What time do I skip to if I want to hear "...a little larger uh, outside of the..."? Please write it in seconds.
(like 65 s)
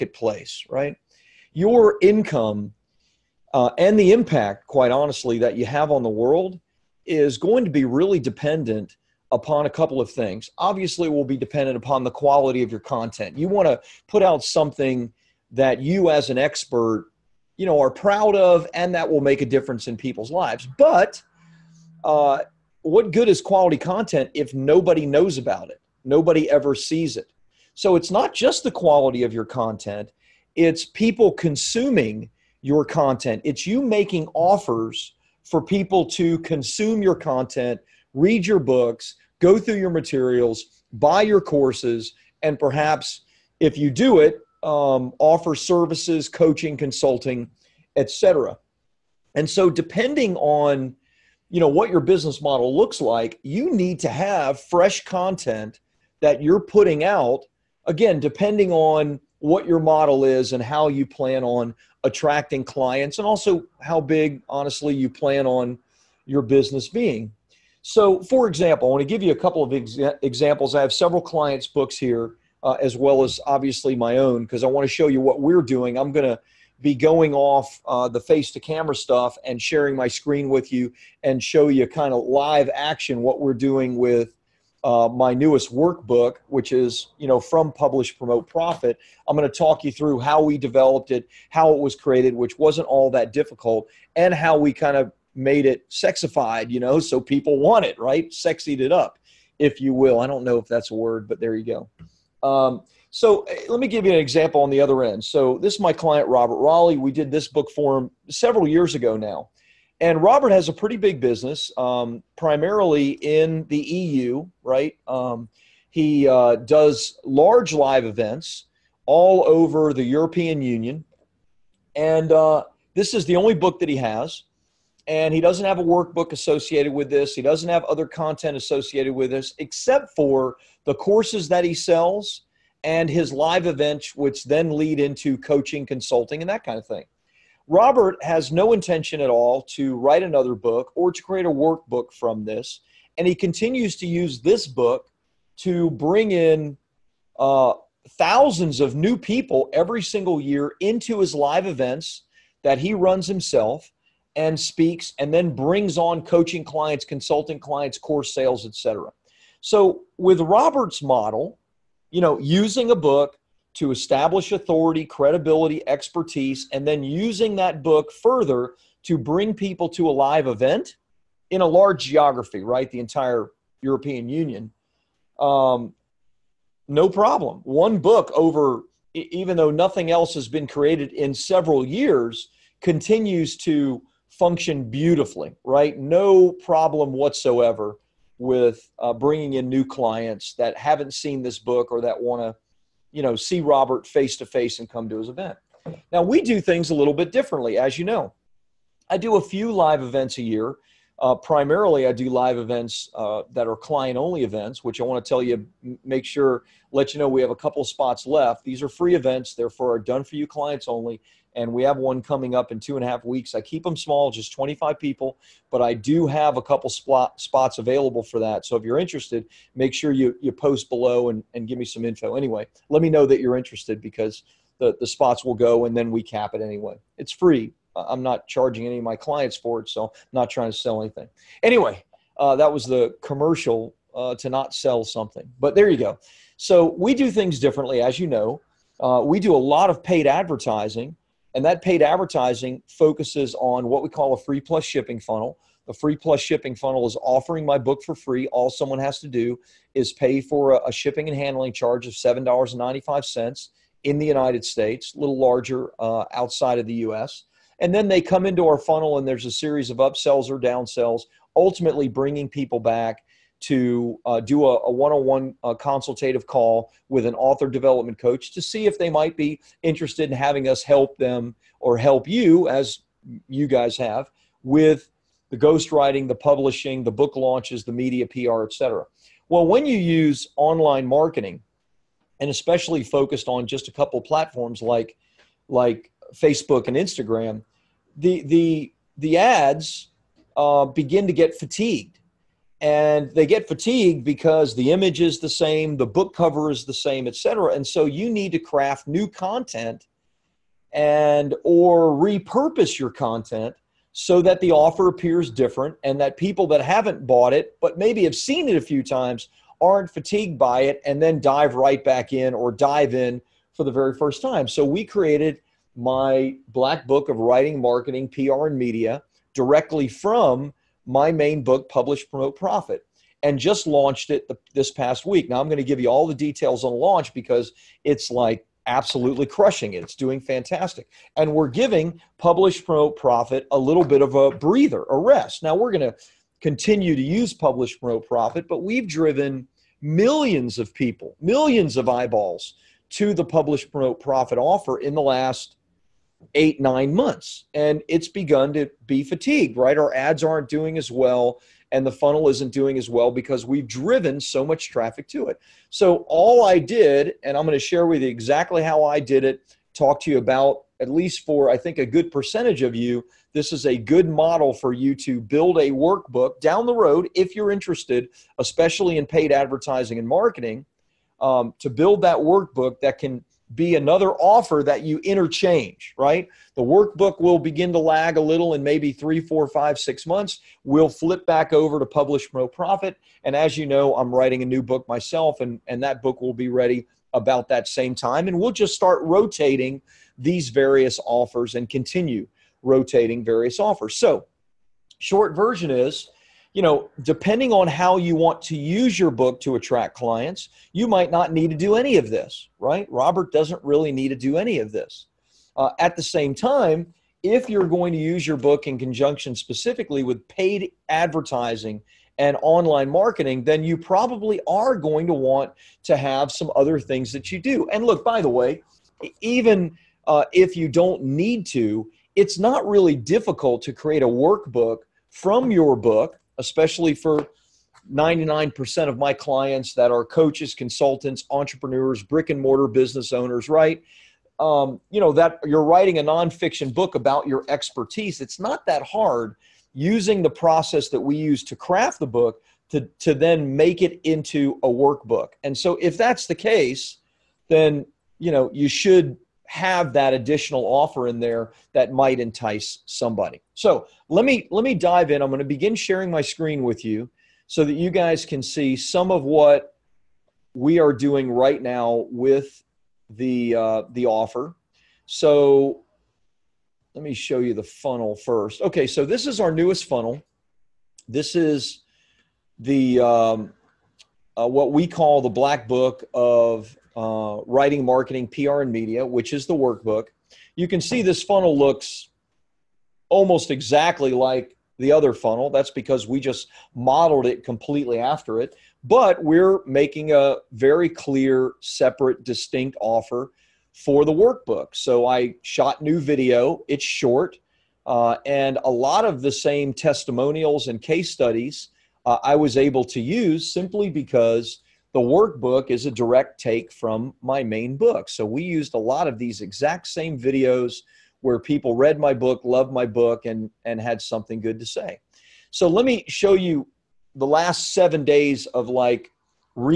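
255 s.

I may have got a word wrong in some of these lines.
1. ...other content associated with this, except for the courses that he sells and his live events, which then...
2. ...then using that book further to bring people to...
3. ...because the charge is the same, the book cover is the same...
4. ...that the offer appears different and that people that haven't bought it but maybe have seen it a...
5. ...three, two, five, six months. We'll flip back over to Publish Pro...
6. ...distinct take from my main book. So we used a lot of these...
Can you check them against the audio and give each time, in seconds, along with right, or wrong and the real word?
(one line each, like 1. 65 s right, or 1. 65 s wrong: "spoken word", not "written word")
1. 127 s right
2. 166 s right
3. 294 s wrong: "image", not "charge"
4. 304 s right
5. 379 s wrong: "four", not "two"
6. 506 s wrong: "direct", not "distinct".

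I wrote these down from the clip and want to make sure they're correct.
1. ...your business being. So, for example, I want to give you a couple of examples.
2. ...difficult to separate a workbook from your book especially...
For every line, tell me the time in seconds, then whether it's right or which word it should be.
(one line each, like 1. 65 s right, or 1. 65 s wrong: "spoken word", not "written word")
1. 66 s right
2. 423 s wrong: "create", not "separate".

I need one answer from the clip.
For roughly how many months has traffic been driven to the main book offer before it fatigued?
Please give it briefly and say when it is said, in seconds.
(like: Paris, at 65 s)
eight, nine months, at 346 s.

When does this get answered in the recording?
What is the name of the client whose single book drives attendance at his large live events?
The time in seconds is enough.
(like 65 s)
106 s.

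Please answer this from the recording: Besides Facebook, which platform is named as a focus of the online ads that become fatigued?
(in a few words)
Instagram.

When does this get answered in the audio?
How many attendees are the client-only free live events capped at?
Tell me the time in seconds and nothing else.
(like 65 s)
214 s.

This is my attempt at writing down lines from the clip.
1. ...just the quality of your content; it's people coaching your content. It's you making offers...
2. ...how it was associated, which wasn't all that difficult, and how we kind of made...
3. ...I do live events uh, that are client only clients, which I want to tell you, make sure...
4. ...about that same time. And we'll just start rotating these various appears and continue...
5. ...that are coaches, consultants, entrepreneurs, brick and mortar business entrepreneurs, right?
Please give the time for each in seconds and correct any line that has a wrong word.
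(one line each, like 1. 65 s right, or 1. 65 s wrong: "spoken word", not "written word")
1. 28 s wrong: "consuming", not "coaching"
2. 91 s wrong: "created", not "associated"
3. 202 s wrong: "events", not "clients"
4. 387 s wrong: "offers", not "appears"
5. 429 s wrong: "owners", not "entrepreneurs".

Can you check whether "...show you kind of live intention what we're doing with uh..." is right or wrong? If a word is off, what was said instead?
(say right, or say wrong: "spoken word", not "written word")
wrong: "action", not "intention".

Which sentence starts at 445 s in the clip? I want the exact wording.
And so if that's the case, then, you know, you should have that additional offer in there that might entice somebody.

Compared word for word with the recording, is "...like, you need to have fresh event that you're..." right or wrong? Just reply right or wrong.
wrong.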